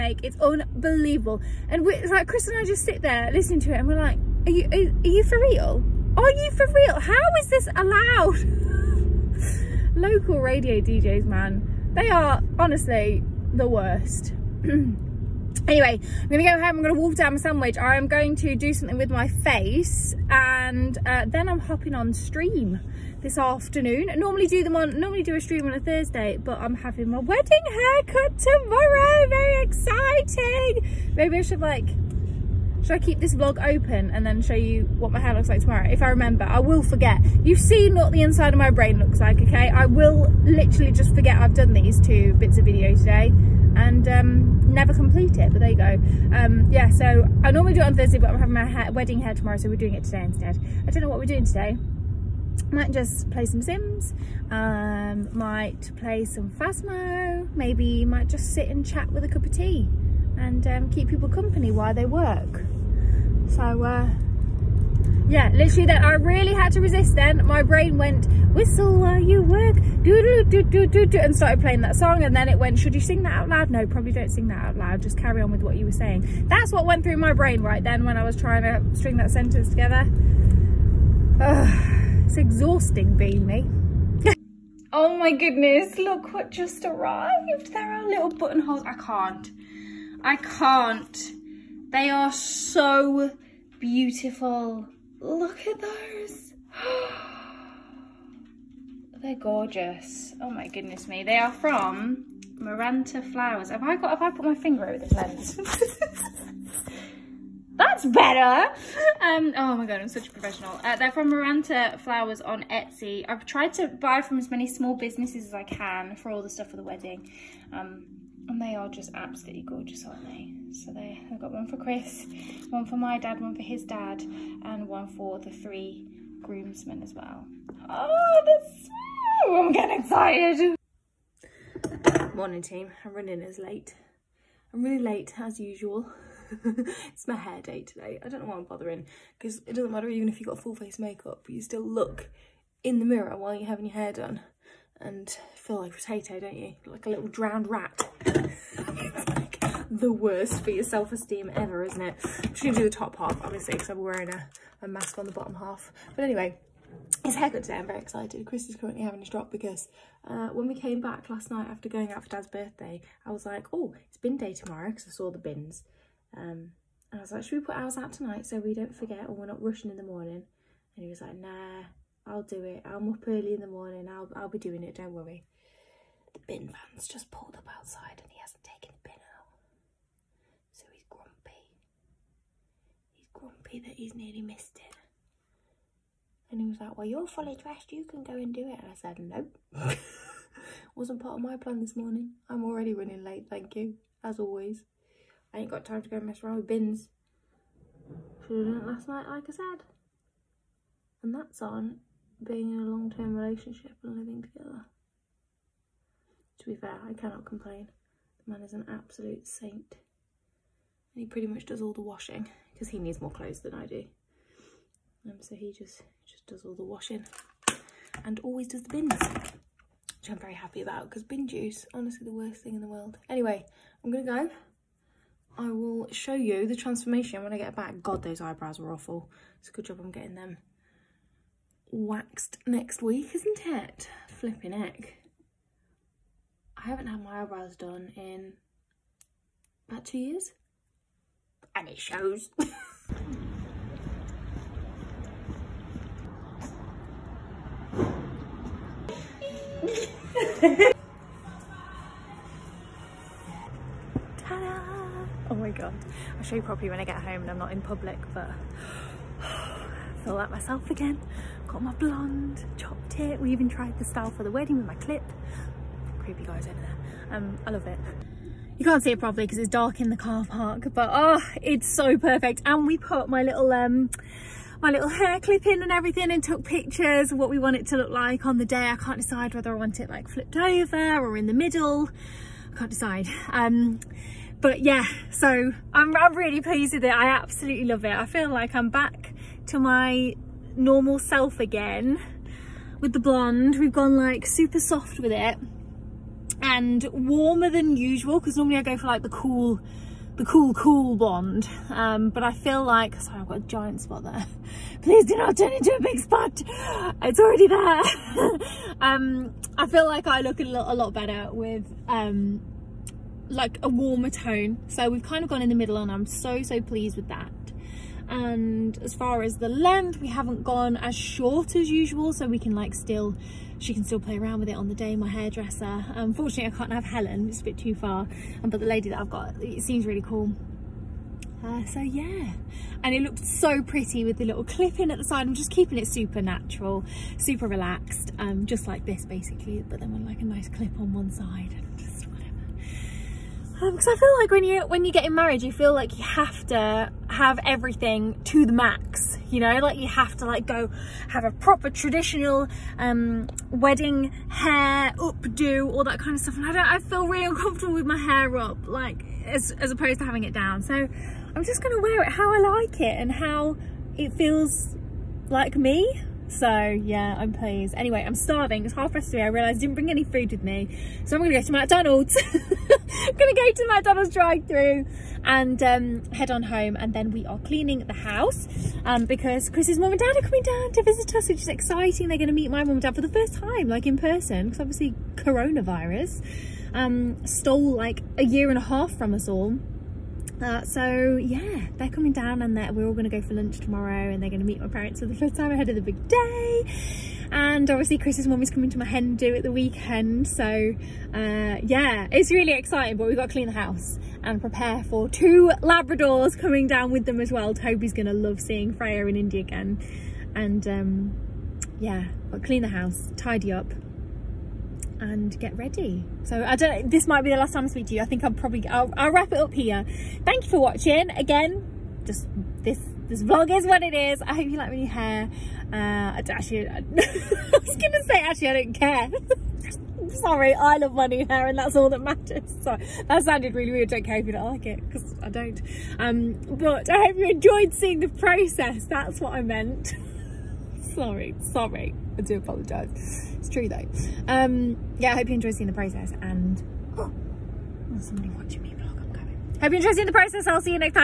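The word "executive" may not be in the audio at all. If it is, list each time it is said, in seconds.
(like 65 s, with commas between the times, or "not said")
not said.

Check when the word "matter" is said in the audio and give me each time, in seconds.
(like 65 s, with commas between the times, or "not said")
139 s, 432 s.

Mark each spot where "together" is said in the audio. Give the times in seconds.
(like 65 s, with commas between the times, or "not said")
79 s, 204 s.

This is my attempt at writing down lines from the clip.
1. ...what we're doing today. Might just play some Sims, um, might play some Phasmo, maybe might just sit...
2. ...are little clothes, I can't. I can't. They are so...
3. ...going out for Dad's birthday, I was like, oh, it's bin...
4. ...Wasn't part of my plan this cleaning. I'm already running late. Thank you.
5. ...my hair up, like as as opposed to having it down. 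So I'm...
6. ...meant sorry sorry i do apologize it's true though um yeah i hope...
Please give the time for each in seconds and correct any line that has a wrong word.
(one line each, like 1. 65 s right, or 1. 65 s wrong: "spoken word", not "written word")
1. 51 s right
2. 87 s wrong: "buttonholes", not "clothes"
3. 161 s right
4. 190 s wrong: "morning", not "cleaning"
5. 358 s right
6. 439 s right.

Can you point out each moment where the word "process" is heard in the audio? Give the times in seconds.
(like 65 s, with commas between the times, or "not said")
438 s, 445 s, 450 s.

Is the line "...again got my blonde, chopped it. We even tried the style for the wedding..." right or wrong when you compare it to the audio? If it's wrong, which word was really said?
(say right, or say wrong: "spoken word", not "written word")
right.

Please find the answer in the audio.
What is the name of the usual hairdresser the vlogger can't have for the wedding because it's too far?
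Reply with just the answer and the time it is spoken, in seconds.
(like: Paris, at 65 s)
Helen, at 327 s.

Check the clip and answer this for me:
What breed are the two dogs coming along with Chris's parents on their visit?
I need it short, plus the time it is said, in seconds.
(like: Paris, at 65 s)
Labradors, at 405 s.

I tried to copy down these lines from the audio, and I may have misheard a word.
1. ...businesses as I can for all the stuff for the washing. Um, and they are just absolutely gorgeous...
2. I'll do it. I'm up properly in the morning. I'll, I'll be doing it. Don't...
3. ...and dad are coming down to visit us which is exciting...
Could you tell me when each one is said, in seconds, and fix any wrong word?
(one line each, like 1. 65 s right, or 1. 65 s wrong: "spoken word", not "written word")
1. 114 s wrong: "wedding", not "washing"
2. 172 s wrong: "early", not "properly"
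3. 380 s right.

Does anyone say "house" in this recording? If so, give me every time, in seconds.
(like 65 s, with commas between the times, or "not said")
378 s, 403 s, 412 s.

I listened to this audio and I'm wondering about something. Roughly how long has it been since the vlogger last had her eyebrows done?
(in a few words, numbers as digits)
About 2 years.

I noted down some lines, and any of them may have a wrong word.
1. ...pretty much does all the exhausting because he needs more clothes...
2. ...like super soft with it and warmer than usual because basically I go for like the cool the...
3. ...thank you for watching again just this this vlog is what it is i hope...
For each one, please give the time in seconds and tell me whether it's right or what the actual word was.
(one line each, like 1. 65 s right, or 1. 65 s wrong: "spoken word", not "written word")
1. 211 s wrong: "washing", not "exhausting"
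2. 294 s wrong: "normally", not "basically"
3. 420 s right.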